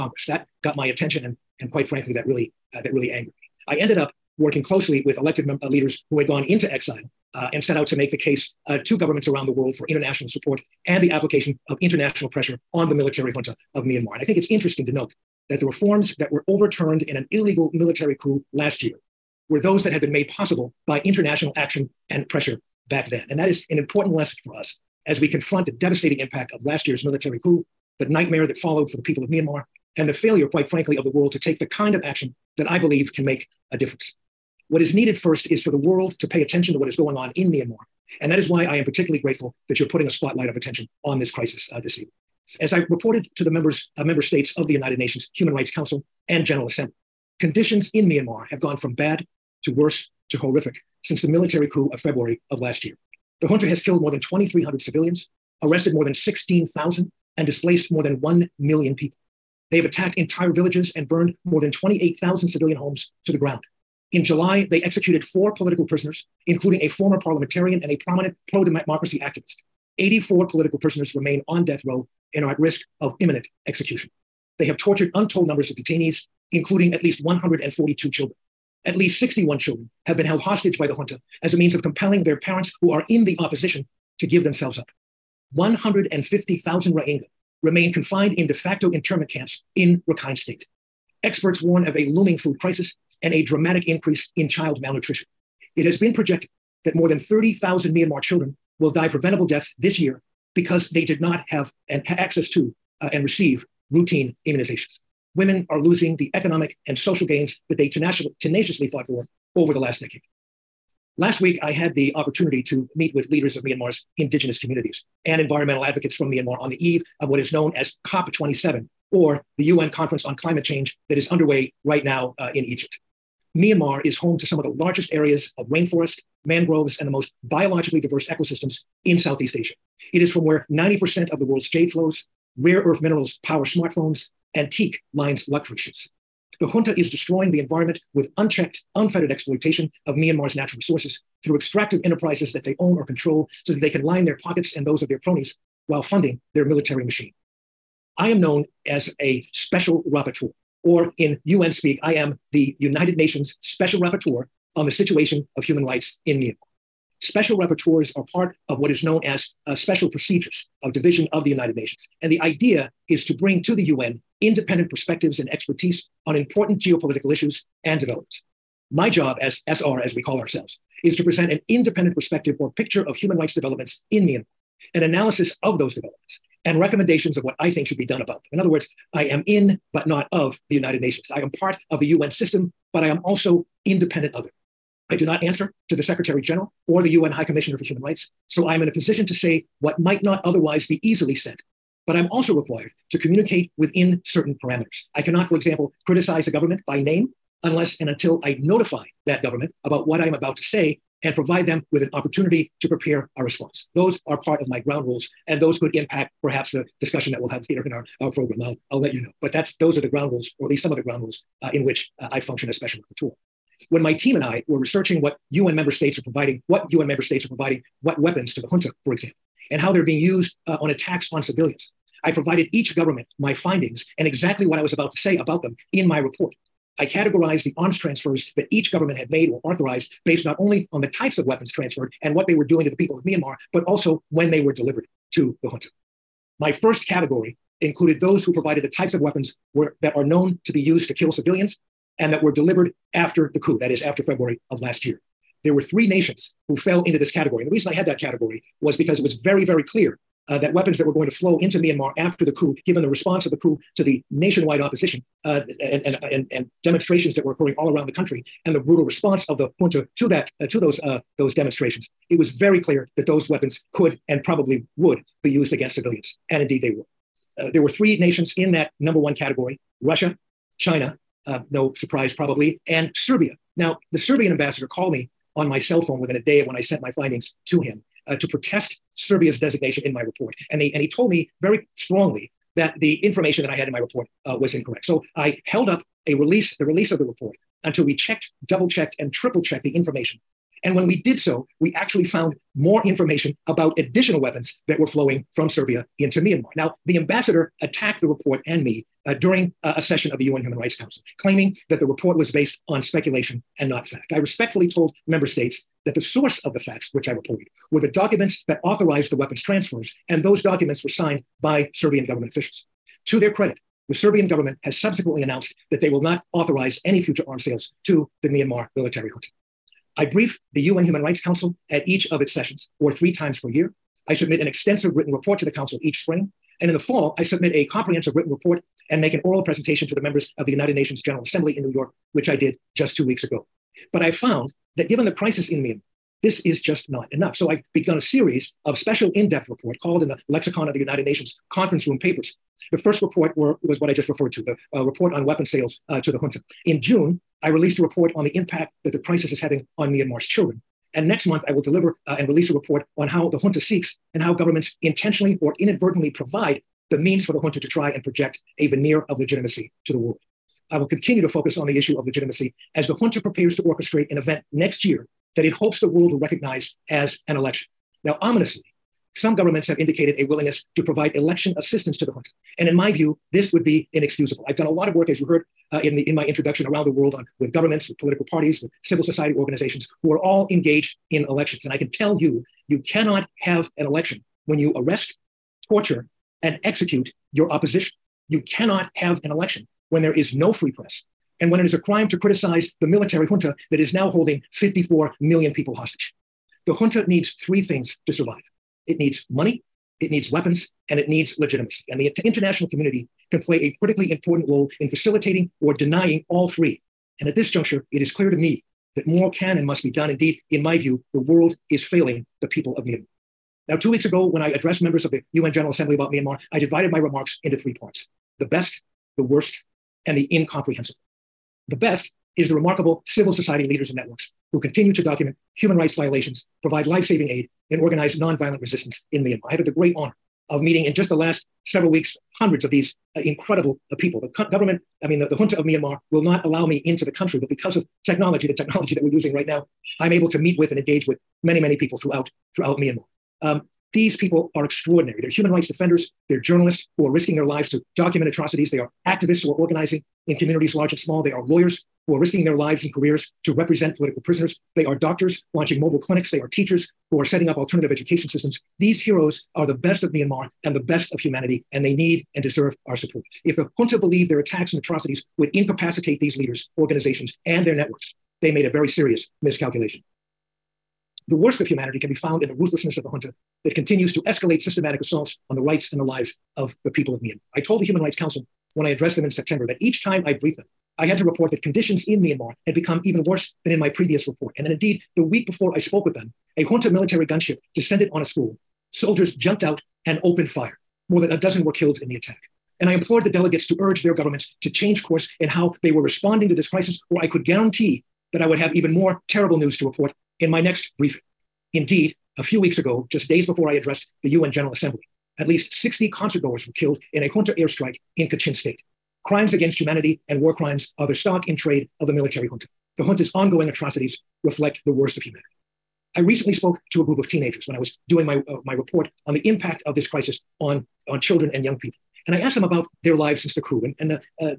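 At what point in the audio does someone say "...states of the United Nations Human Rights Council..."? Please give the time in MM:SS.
00:44.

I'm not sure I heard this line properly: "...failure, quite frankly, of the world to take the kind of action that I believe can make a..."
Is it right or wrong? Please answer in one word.
right.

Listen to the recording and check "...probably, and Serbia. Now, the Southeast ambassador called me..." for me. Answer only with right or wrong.
wrong.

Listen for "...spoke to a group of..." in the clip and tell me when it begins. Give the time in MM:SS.
08:36.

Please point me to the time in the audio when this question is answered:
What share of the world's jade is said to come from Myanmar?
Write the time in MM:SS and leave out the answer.
02:10.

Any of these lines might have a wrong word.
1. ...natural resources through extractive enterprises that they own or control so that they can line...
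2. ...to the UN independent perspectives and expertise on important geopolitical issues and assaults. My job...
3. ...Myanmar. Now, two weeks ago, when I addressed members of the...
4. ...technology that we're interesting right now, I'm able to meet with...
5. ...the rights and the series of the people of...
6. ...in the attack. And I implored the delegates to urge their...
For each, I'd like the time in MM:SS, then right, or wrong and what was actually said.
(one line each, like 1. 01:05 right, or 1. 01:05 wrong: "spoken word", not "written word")
1. 02:20 right
2. 02:43 wrong: "developments", not "assaults"
3. 06:53 right
4. 07:18 wrong: "using", not "interesting"
5. 07:55 wrong: "lives", not "series"
6. 08:12 right.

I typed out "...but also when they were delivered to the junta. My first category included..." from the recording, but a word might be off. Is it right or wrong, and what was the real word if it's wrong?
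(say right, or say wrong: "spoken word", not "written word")
right.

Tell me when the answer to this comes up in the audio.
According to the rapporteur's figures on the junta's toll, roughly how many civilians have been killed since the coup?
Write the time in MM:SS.
00:54.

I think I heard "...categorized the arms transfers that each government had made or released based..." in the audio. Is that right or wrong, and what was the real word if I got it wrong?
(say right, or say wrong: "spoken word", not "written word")
wrong: "authorized", not "released".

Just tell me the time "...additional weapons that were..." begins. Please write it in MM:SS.
04:53.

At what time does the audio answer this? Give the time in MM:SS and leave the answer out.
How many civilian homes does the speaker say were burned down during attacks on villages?
01:01.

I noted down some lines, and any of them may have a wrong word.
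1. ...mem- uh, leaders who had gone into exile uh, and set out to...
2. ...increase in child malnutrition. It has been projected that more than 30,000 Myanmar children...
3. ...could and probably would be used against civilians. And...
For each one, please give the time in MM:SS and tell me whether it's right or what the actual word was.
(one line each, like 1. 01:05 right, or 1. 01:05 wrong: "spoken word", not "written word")
1. 00:05 right
2. 01:33 right
3. 04:23 right.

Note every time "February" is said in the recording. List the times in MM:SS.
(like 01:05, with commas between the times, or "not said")
00:51, 04:04.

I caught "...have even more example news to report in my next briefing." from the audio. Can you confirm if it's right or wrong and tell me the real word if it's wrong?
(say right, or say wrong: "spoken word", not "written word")
wrong: "terrible", not "example".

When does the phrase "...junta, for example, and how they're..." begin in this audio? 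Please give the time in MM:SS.
03:38.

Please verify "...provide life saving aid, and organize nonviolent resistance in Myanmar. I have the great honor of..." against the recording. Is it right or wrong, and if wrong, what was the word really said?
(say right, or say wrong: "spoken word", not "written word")
right.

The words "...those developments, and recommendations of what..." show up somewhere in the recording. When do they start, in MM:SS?
02:55.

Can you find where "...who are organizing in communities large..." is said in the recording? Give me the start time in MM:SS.
07:29.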